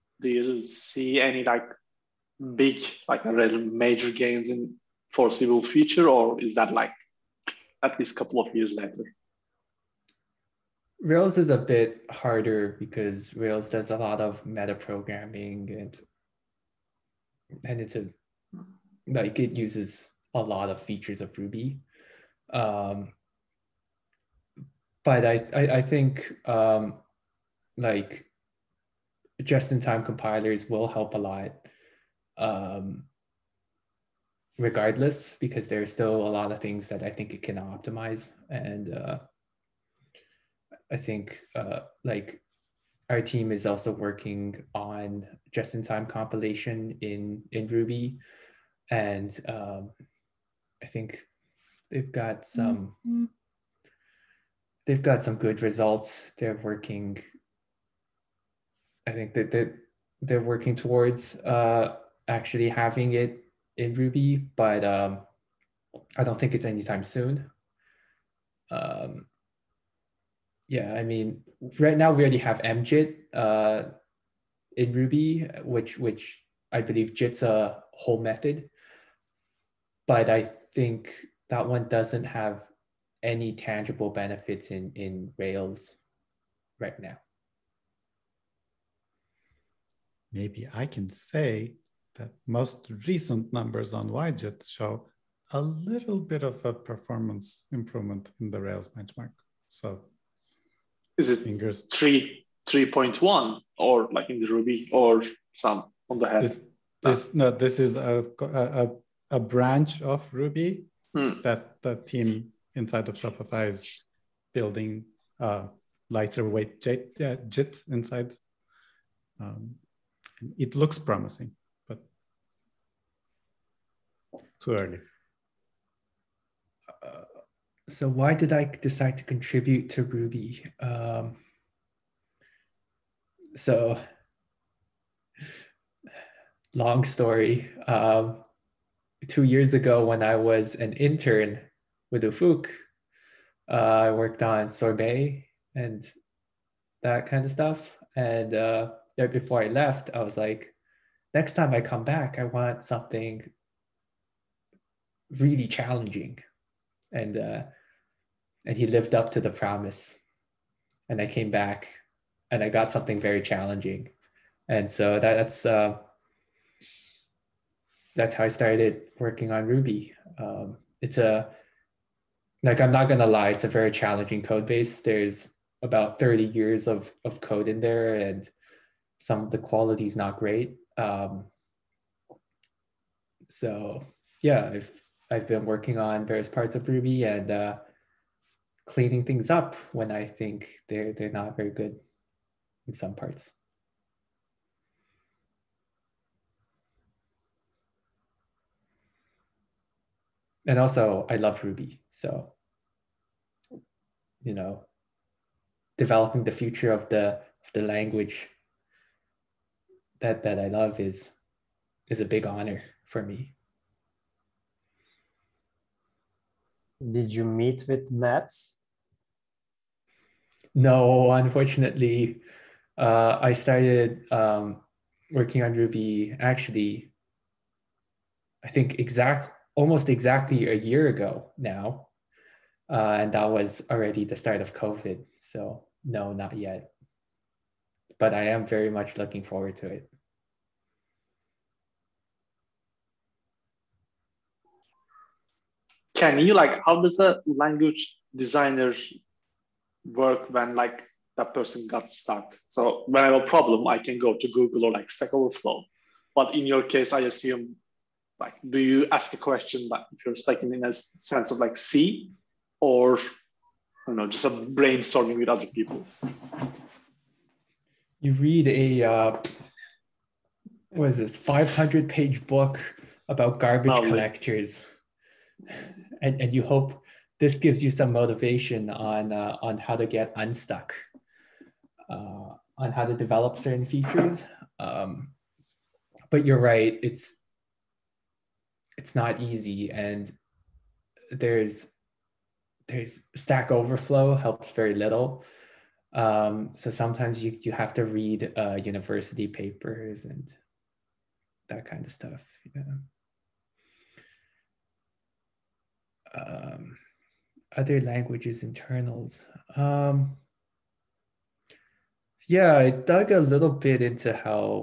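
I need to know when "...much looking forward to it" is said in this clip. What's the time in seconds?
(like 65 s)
238 s.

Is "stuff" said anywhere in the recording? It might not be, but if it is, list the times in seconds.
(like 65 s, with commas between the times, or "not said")
147 s, 302 s.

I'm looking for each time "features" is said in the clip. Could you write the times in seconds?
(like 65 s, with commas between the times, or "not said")
20 s, 283 s.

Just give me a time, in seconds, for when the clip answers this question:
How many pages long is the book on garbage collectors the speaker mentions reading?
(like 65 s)
271 s.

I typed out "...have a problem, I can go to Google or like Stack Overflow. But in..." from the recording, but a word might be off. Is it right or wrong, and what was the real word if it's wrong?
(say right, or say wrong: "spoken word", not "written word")
right.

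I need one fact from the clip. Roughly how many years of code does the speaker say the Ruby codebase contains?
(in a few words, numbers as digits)
30 years.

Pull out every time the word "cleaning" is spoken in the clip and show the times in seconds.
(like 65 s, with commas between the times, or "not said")
188 s.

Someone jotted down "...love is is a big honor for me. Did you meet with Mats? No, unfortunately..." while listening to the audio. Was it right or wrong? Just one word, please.
right.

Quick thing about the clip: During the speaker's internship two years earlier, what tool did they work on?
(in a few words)
Sorbet.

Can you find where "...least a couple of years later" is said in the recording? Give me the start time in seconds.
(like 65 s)
7 s.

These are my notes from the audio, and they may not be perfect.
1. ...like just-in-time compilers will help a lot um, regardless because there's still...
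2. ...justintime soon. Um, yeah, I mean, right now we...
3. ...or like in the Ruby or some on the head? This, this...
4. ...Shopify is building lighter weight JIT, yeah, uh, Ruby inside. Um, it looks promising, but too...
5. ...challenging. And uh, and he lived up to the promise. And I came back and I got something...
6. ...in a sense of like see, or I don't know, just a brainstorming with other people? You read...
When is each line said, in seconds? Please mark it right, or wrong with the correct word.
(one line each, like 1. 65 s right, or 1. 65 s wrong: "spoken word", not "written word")
1. 27 s right
2. 66 s wrong: "anytime", not "justintime"
3. 103 s right
4. 113 s wrong: "JIT", not "Ruby"
5. 155 s right
6. 260 s right.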